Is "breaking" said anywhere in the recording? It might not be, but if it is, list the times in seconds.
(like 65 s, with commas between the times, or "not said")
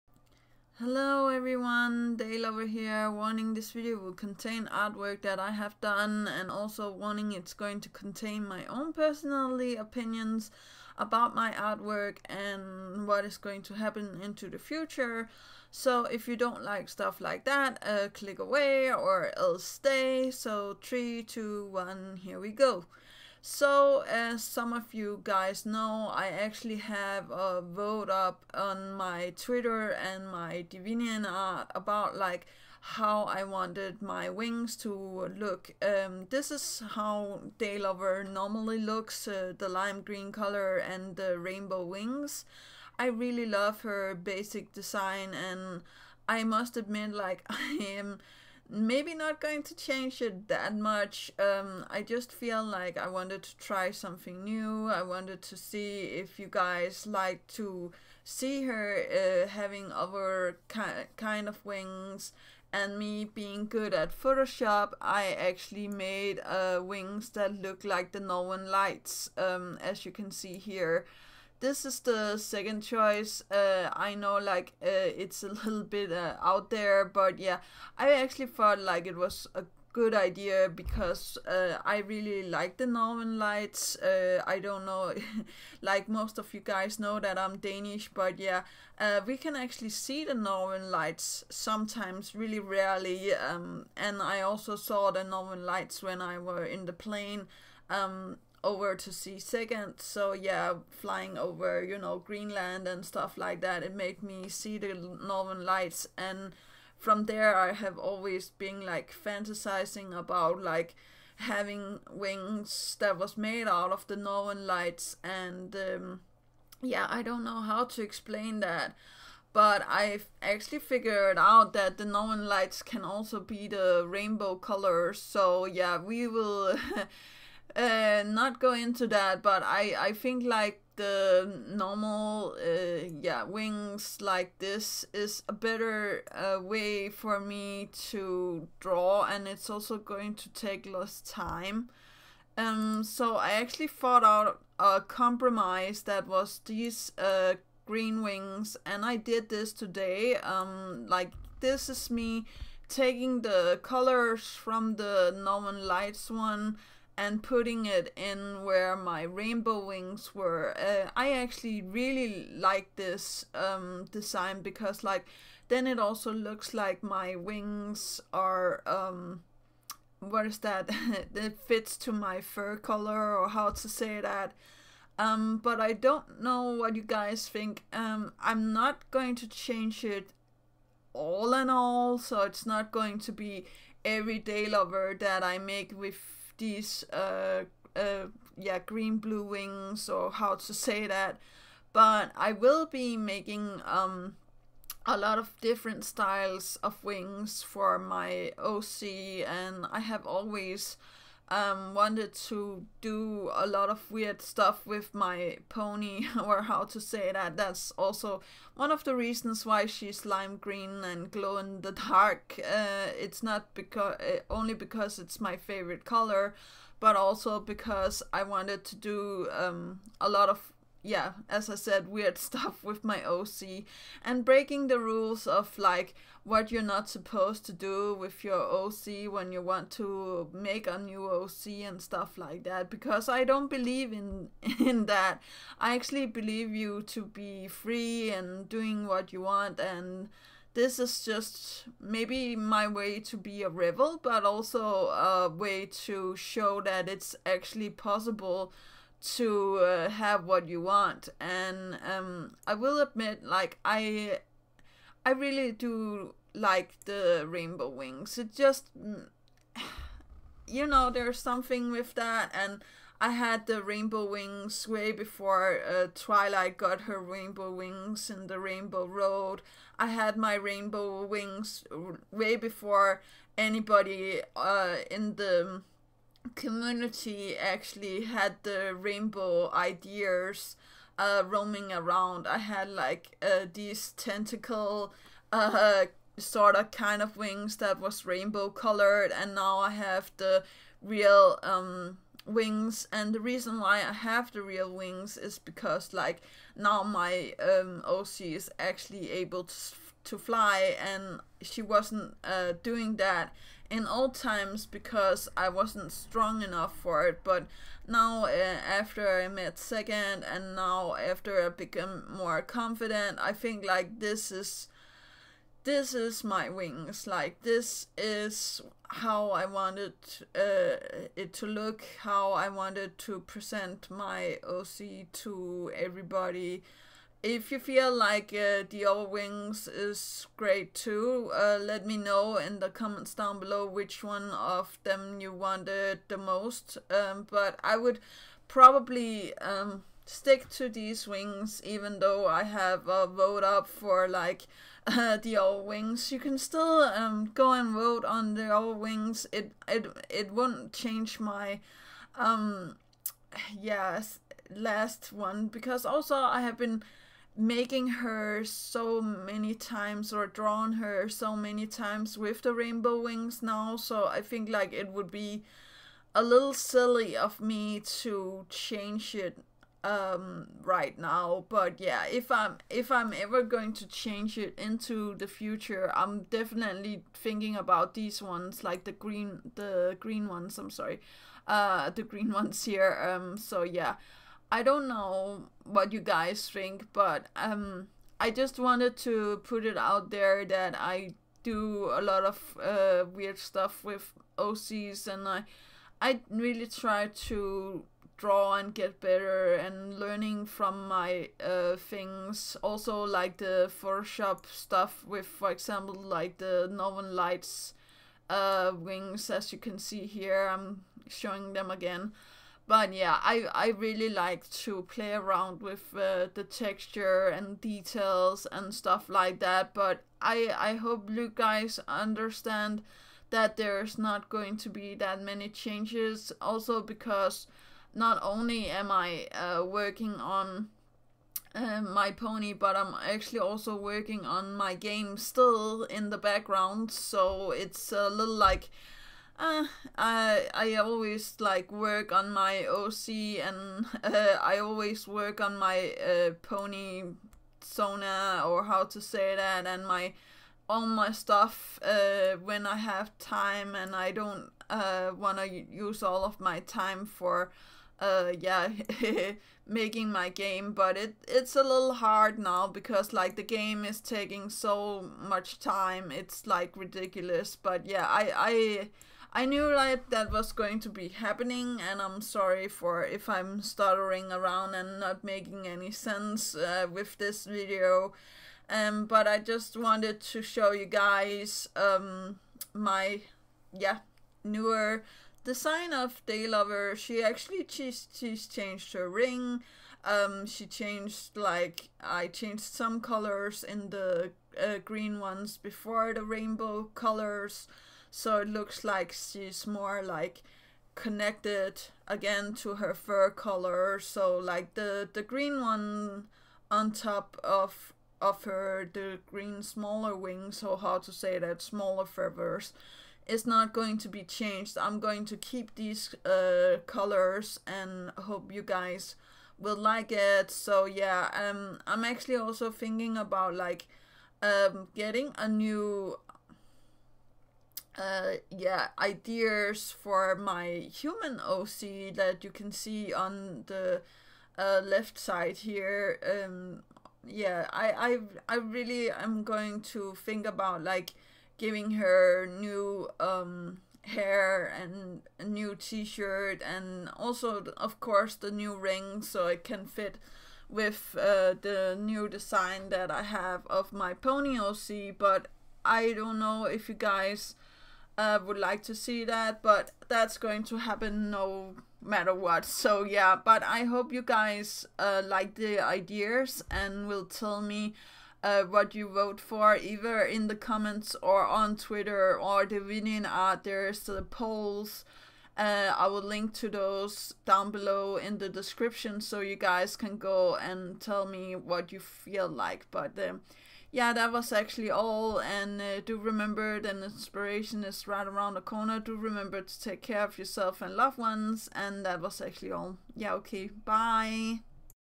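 224 s.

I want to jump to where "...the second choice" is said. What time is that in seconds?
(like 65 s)
72 s.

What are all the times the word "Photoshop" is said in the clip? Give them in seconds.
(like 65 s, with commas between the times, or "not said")
64 s, 404 s.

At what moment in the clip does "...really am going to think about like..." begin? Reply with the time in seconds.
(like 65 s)
538 s.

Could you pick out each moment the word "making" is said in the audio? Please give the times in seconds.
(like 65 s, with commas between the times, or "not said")
193 s, 357 s, 459 s, 475 s.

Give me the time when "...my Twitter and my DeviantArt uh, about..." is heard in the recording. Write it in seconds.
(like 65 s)
28 s.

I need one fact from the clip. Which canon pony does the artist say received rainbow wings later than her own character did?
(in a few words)
Twilight.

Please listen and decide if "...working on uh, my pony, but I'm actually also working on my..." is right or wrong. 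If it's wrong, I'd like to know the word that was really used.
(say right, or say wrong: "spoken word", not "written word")
right.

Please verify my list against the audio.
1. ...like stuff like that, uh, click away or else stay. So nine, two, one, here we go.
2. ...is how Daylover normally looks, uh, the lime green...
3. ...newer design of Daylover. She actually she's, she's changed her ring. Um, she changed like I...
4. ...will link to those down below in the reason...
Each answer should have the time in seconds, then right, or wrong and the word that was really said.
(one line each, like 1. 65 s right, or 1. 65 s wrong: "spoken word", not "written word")
1. 16 s wrong: "three", not "nine"
2. 36 s right
3. 484 s right
4. 576 s wrong: "description", not "reason".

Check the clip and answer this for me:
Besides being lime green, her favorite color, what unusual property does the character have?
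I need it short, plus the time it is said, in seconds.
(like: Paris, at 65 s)
Glow in the dark, at 211 s.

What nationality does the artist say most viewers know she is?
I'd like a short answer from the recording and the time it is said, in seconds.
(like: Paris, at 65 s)
Danish, at 87 s.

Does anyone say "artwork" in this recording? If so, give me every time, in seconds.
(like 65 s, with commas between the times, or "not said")
4 s, 11 s.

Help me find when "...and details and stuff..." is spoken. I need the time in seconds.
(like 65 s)
417 s.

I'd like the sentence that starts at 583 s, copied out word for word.
But um, yeah, that was actually all.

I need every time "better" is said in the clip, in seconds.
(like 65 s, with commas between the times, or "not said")
135 s, 399 s.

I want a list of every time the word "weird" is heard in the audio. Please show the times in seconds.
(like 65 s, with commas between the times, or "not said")
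204 s, 222 s, 393 s.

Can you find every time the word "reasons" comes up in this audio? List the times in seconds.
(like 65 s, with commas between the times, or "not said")
209 s, 293 s.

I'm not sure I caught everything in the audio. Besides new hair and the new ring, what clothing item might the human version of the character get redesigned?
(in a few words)
T-shirt.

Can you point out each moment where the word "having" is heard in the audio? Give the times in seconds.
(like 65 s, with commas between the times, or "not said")
59 s, 111 s.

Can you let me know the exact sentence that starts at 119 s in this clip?
But I've actually figured out that the northern lights can also be the rainbow colors.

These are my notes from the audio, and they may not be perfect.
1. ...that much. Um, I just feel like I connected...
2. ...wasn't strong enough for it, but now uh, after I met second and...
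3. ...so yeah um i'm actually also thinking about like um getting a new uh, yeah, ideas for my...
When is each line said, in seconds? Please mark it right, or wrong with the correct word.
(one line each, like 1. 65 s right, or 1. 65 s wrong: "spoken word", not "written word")
1. 50 s wrong: "wanted", not "connected"
2. 305 s right
3. 520 s right.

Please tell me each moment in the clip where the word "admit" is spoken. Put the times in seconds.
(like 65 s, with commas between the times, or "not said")
46 s, 252 s.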